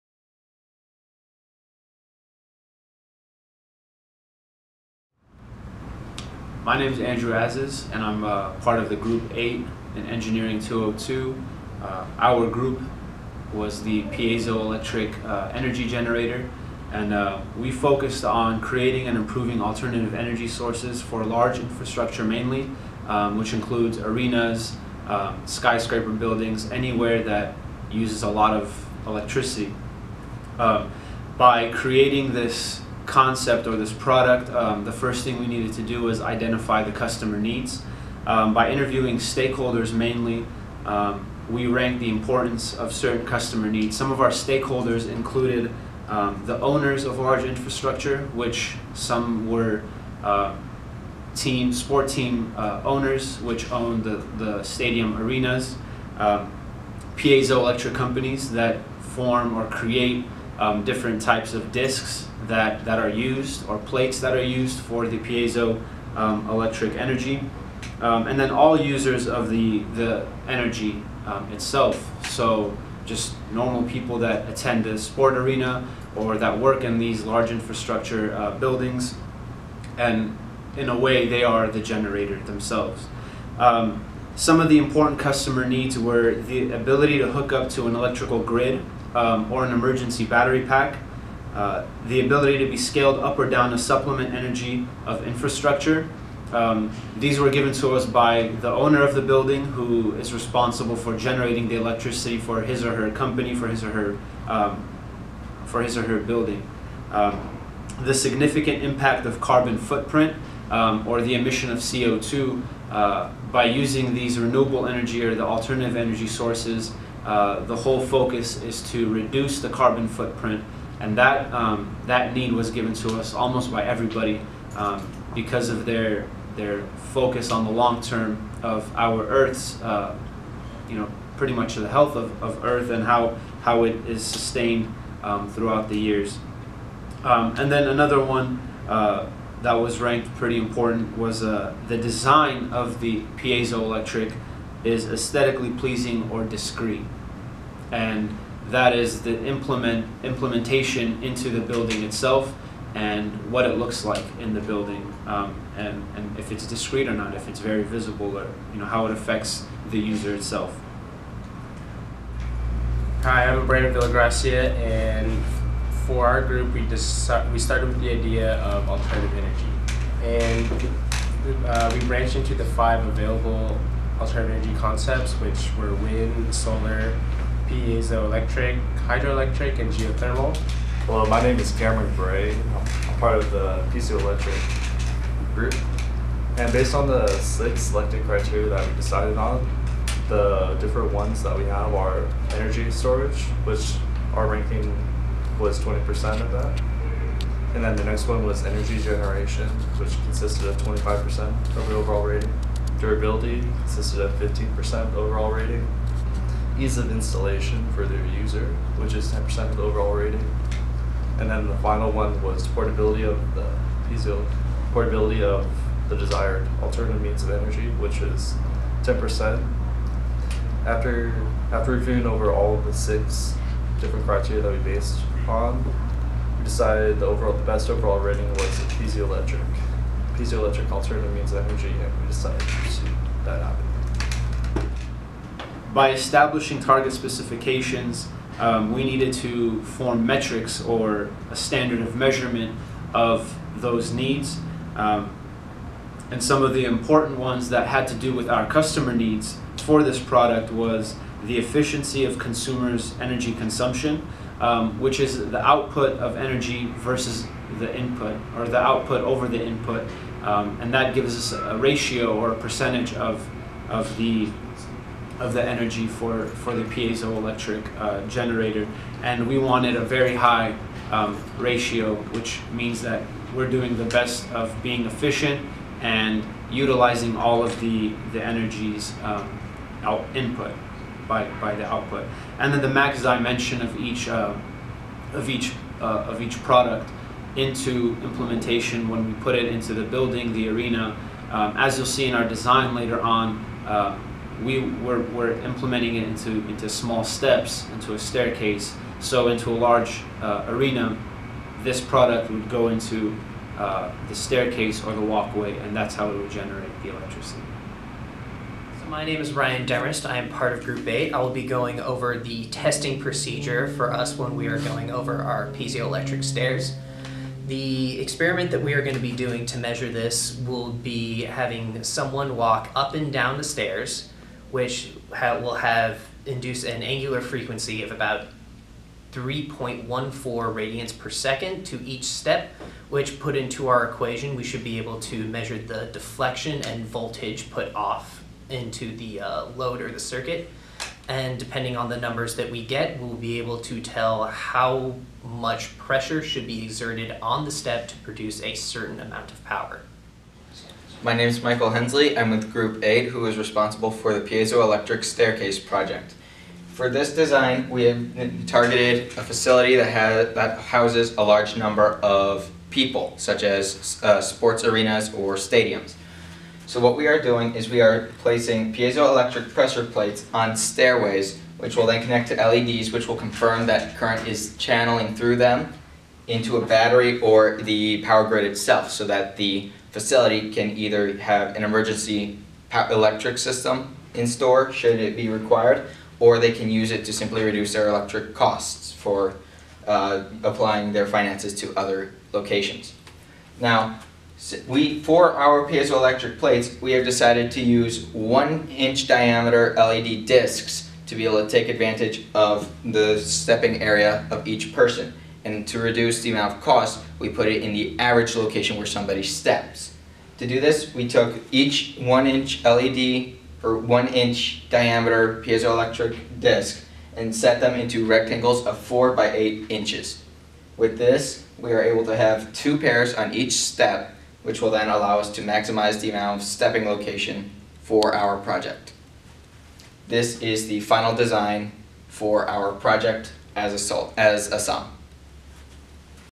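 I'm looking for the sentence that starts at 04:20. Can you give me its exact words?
Um, and that gives us a ratio or a percentage of, of the of the energy for, for the piezoelectric uh, generator.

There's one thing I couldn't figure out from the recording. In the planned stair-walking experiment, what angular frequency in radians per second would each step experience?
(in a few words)
3.14.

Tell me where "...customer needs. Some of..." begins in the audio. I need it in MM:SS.
00:43.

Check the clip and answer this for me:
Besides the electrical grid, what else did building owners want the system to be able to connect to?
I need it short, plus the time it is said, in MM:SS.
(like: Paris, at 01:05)
emergency battery pack, at 01:29.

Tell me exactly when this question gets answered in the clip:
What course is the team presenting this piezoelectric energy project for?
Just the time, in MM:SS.
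00:10.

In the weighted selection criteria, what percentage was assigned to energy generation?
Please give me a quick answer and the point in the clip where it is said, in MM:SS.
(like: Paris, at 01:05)
25%, at 03:20.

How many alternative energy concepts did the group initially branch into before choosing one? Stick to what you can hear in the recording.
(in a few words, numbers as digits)
5.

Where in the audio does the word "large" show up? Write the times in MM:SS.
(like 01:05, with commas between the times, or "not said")
00:21, 00:47, 01:17, 04:59, 06:01.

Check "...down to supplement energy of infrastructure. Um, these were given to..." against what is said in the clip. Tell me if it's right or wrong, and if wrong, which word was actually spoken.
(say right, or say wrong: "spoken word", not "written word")
right.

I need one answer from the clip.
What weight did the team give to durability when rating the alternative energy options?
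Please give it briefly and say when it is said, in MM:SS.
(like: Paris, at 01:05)
15%, at 03:24.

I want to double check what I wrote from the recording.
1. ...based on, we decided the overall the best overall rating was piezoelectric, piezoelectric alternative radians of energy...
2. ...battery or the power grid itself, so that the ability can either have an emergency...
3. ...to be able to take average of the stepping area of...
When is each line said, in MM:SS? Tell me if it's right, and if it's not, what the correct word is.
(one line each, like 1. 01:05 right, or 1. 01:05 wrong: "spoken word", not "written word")
1. 03:44 wrong: "means", not "radians"
2. 06:16 wrong: "facility", not "ability"
3. 06:41 wrong: "advantage", not "average".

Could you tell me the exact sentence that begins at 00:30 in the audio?
Um, by creating this concept or this product, um, the first thing we needed to do was identify the customer needs.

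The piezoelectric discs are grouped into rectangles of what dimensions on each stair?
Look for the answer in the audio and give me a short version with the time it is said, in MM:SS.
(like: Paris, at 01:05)
4 by 8 inches, at 06:58.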